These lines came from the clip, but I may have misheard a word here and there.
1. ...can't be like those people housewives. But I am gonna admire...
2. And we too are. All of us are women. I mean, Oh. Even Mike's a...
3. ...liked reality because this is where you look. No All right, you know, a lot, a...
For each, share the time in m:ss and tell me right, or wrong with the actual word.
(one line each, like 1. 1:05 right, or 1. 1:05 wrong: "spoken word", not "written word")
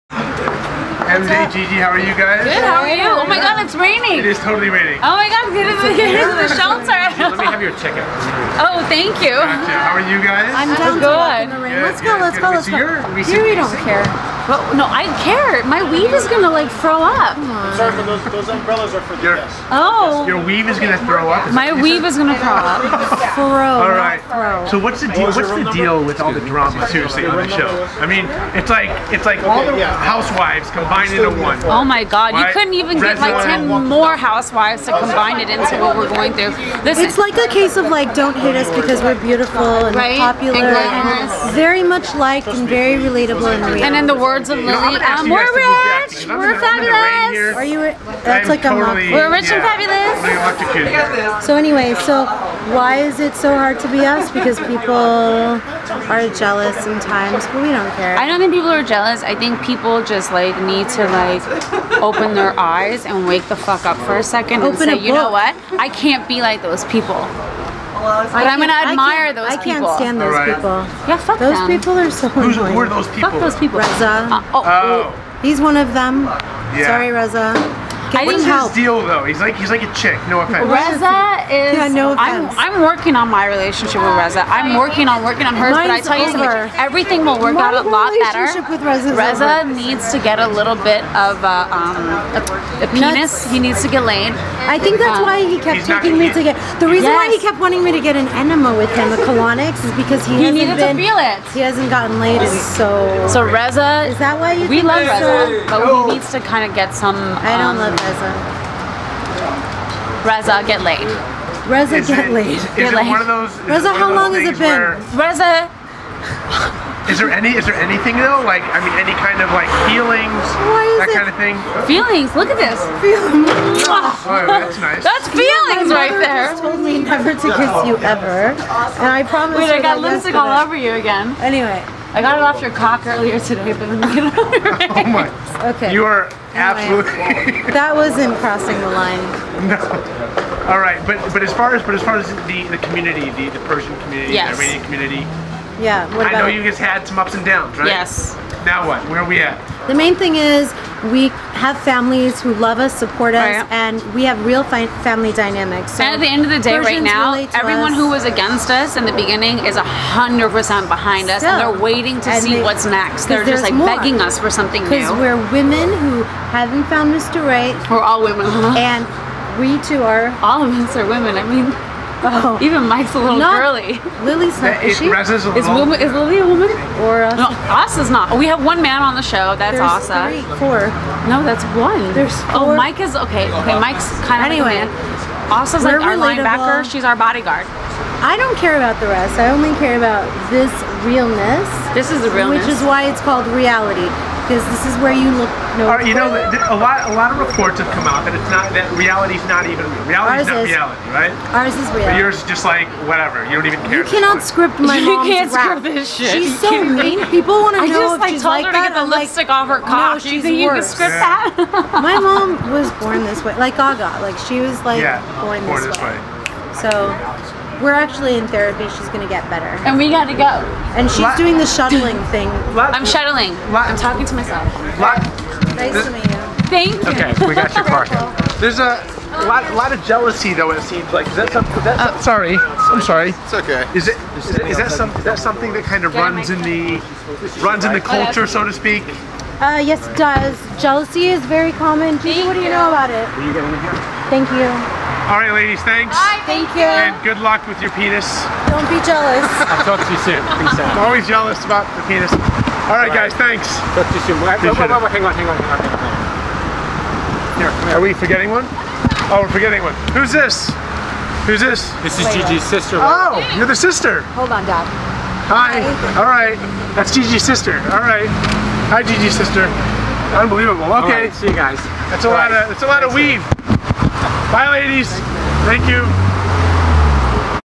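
1. 1:05 wrong: "clothes", not "housewives"
2. 2:48 right
3. 3:13 wrong: "called", not "liked".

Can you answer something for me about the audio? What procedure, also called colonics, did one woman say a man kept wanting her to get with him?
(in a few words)
an enema.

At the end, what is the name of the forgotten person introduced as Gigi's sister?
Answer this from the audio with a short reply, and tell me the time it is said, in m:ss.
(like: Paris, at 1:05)
Layla, at 4:22.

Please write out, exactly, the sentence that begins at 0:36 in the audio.
This it's like a case of like, don't hate us because we're beautiful and right?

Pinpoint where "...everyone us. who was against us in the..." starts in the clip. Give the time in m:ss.
2:37.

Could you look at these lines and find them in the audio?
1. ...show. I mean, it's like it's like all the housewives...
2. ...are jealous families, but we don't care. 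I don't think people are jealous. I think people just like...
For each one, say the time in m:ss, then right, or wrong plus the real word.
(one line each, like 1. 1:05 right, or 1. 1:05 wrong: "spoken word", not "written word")
1. 0:27 right
2. 0:54 wrong: "sometimes", not "families".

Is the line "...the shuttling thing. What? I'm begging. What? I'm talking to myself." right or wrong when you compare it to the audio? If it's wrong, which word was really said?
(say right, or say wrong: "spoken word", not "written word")
wrong: "shuttling", not "begging".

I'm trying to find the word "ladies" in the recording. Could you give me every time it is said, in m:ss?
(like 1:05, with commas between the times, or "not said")
4:05, 4:34.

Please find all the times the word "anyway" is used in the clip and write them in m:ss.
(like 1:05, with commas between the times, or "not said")
0:51, 2:11, 3:04.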